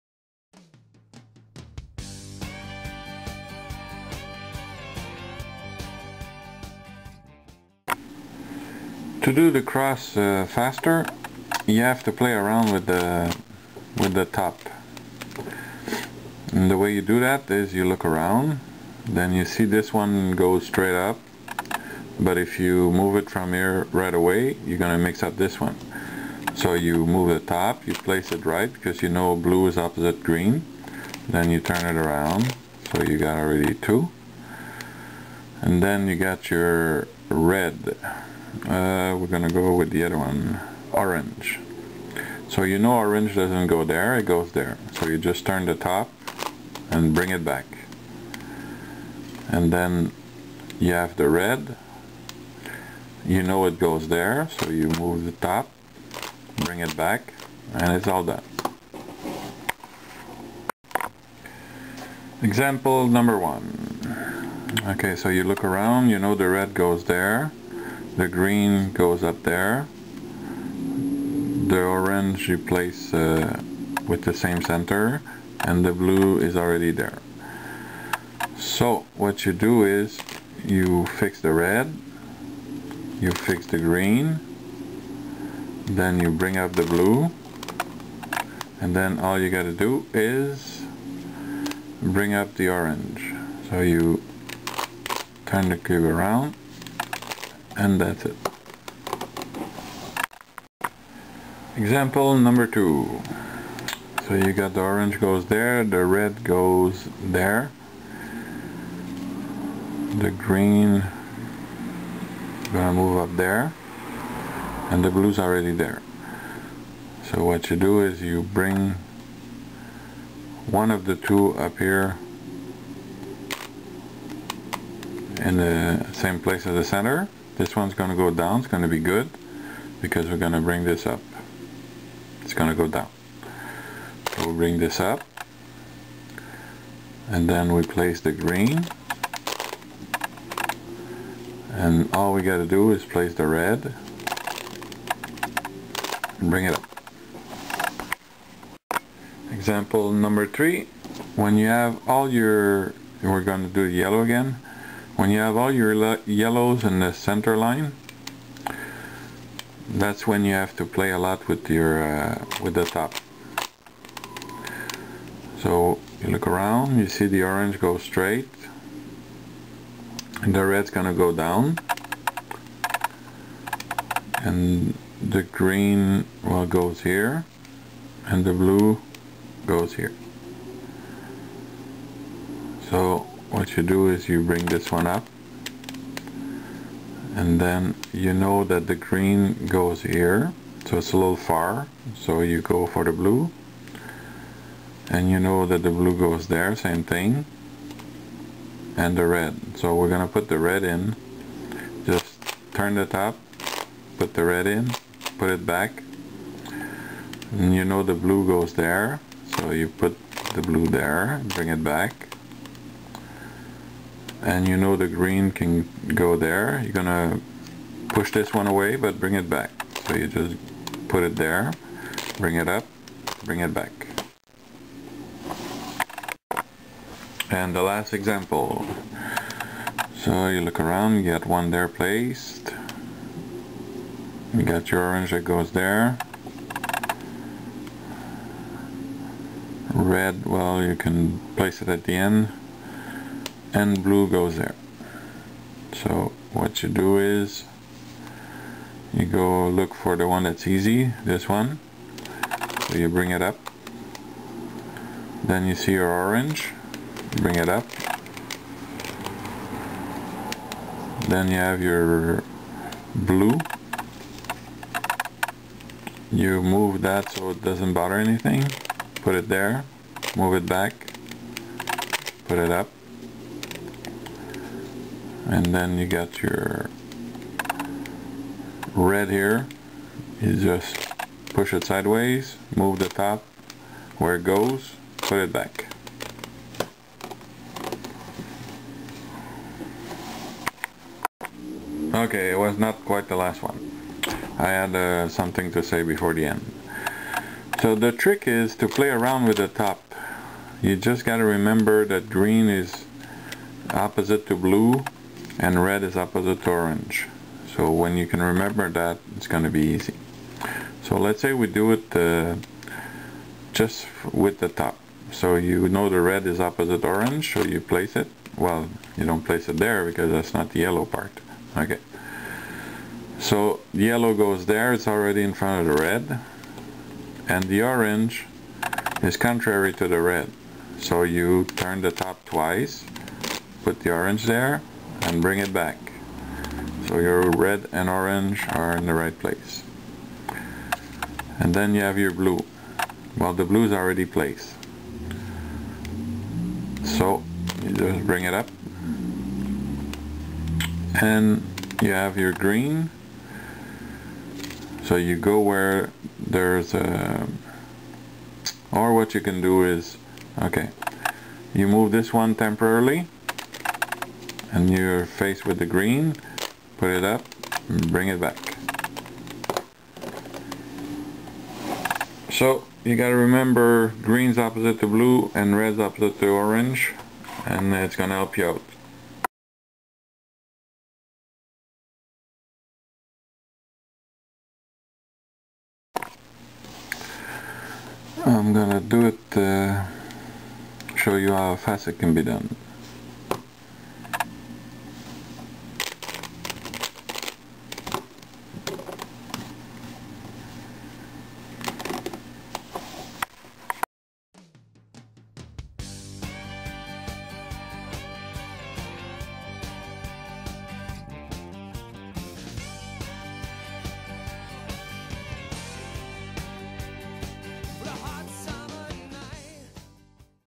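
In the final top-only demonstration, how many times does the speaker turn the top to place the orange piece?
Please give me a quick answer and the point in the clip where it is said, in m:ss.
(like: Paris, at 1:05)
Twice, at 5:32.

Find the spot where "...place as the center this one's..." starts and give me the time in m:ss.
2:06.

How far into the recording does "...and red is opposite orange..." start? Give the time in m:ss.
5:05.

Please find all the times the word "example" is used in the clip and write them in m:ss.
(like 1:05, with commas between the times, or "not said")
1:02, 1:41, 2:29, 3:48.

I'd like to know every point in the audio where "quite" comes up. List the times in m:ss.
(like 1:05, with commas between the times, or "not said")
4:53.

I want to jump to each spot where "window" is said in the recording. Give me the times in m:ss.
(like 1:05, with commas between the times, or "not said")
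not said.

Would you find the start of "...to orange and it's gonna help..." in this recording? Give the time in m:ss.
6:16.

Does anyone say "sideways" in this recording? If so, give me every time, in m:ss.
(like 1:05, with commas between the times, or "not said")
4:41.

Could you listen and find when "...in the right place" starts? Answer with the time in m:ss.
5:38.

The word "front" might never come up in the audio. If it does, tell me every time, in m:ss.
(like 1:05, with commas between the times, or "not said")
5:25.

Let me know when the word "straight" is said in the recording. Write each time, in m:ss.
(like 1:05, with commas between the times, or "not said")
0:20, 2:47.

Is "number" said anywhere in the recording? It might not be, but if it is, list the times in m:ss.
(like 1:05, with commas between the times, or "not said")
1:03, 1:42, 2:30.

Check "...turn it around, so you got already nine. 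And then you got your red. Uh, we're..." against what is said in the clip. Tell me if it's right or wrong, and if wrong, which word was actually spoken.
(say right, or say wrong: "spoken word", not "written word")
wrong: "two", not "nine".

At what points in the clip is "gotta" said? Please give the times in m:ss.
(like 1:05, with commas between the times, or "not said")
1:29, 5:01, 6:13.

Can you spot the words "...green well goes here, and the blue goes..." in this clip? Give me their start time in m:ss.
2:55.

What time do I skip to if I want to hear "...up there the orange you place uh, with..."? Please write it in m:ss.
1:09.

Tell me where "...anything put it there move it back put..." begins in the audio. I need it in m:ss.
4:28.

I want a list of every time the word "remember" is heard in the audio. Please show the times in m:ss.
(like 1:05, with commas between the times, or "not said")
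5:01, 5:08, 6:13.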